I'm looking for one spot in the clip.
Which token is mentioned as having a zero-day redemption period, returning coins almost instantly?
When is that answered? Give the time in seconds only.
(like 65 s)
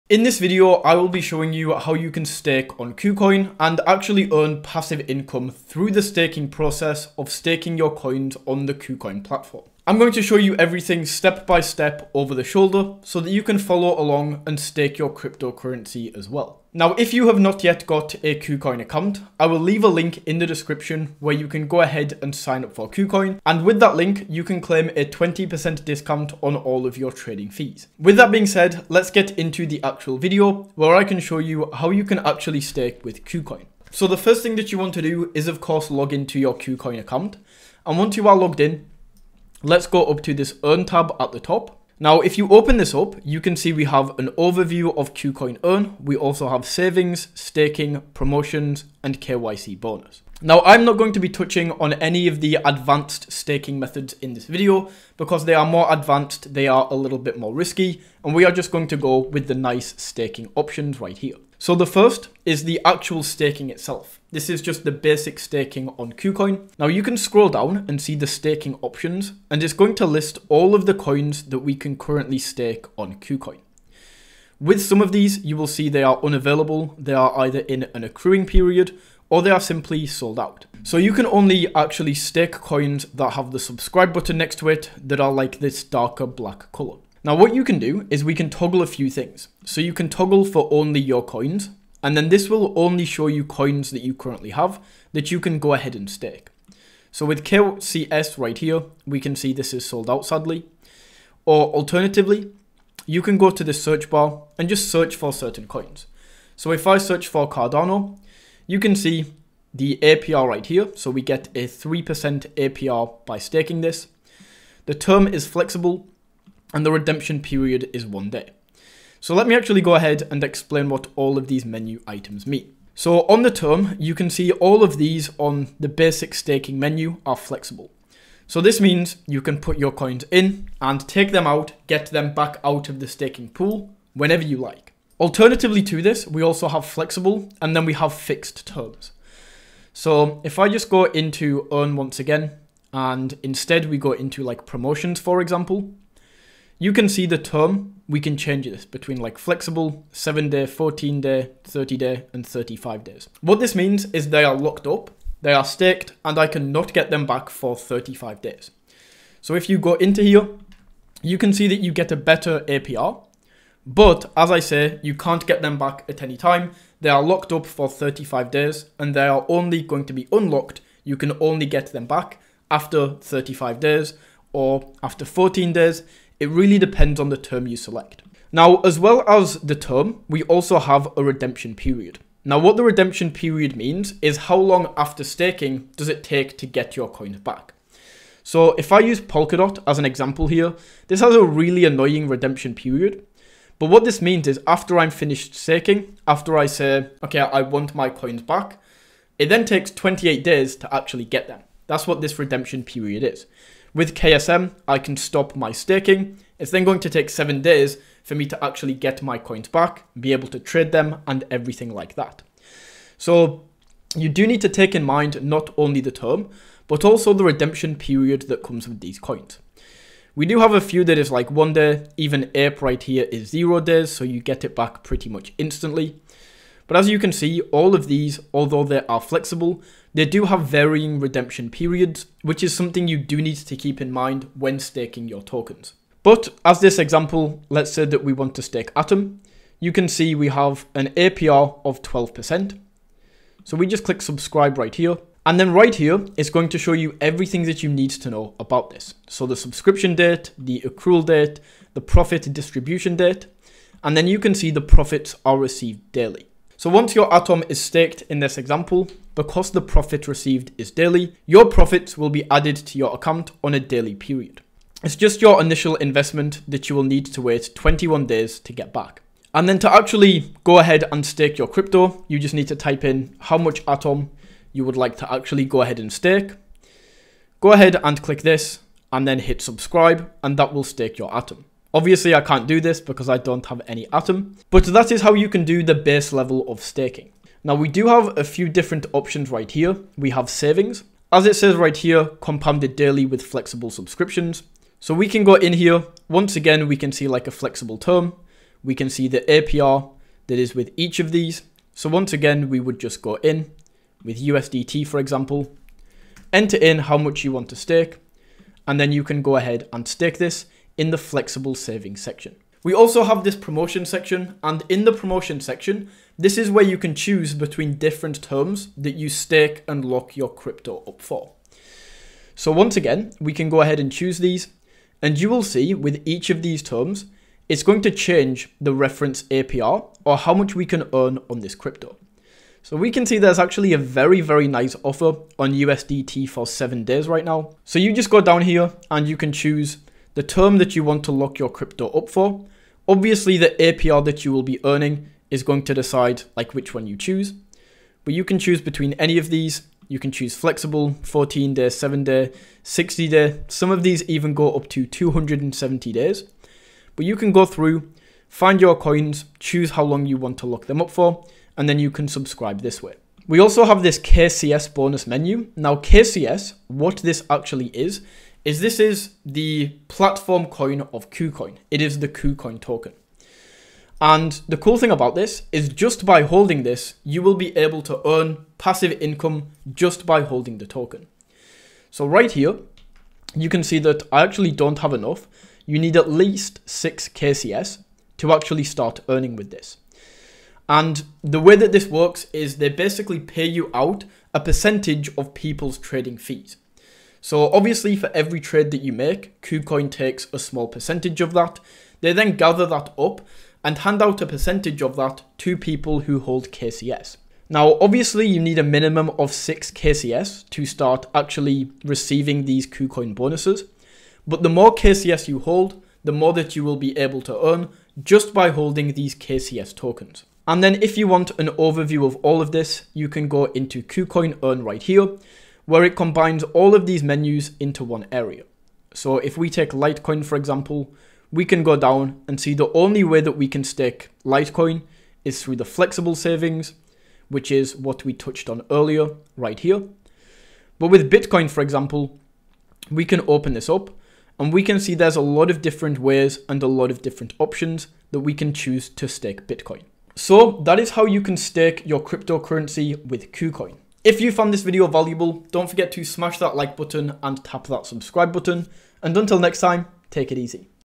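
222 s.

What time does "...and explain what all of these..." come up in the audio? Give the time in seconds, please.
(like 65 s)
120 s.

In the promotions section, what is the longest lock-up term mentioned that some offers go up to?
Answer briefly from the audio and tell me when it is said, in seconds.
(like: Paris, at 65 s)
270 days, at 355 s.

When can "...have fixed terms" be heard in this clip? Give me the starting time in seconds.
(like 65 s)
137 s.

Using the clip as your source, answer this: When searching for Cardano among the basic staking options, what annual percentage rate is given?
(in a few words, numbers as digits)
3%.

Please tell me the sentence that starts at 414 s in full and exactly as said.
But the more KCS you hold, the more that you will be able to earn just by holding these KCS tokens.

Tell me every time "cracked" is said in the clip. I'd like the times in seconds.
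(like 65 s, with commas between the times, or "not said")
not said.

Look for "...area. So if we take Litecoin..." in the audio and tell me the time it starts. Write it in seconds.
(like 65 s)
428 s.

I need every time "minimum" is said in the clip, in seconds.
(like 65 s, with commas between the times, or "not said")
408 s.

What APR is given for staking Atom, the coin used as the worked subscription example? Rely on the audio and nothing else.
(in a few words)
12%.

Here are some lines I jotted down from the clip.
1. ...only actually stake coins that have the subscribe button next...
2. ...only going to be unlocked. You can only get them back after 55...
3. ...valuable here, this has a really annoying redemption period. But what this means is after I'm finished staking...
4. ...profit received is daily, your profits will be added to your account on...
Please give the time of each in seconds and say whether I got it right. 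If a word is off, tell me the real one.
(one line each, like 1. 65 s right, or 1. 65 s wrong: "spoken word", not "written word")
1. 81 s right
2. 169 s wrong: "35", not "55"
3. 190 s wrong: "example", not "valuable"
4. 259 s right.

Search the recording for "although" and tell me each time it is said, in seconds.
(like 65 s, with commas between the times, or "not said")
228 s.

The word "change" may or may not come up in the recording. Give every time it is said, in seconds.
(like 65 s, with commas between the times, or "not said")
148 s, 328 s.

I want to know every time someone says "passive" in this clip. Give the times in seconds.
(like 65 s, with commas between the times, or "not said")
4 s, 378 s.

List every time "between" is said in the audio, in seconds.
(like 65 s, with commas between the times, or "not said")
148 s, 317 s, 348 s.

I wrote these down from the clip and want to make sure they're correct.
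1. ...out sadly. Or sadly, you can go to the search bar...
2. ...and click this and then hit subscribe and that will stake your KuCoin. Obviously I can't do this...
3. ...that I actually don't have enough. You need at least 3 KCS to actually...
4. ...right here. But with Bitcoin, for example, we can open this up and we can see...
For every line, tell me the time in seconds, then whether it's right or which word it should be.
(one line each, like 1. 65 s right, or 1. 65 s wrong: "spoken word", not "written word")
1. 100 s wrong: "alternatively", not "sadly"
2. 278 s wrong: "Atom", not "KuCoin"
3. 383 s wrong: "6", not "3"
4. 439 s right.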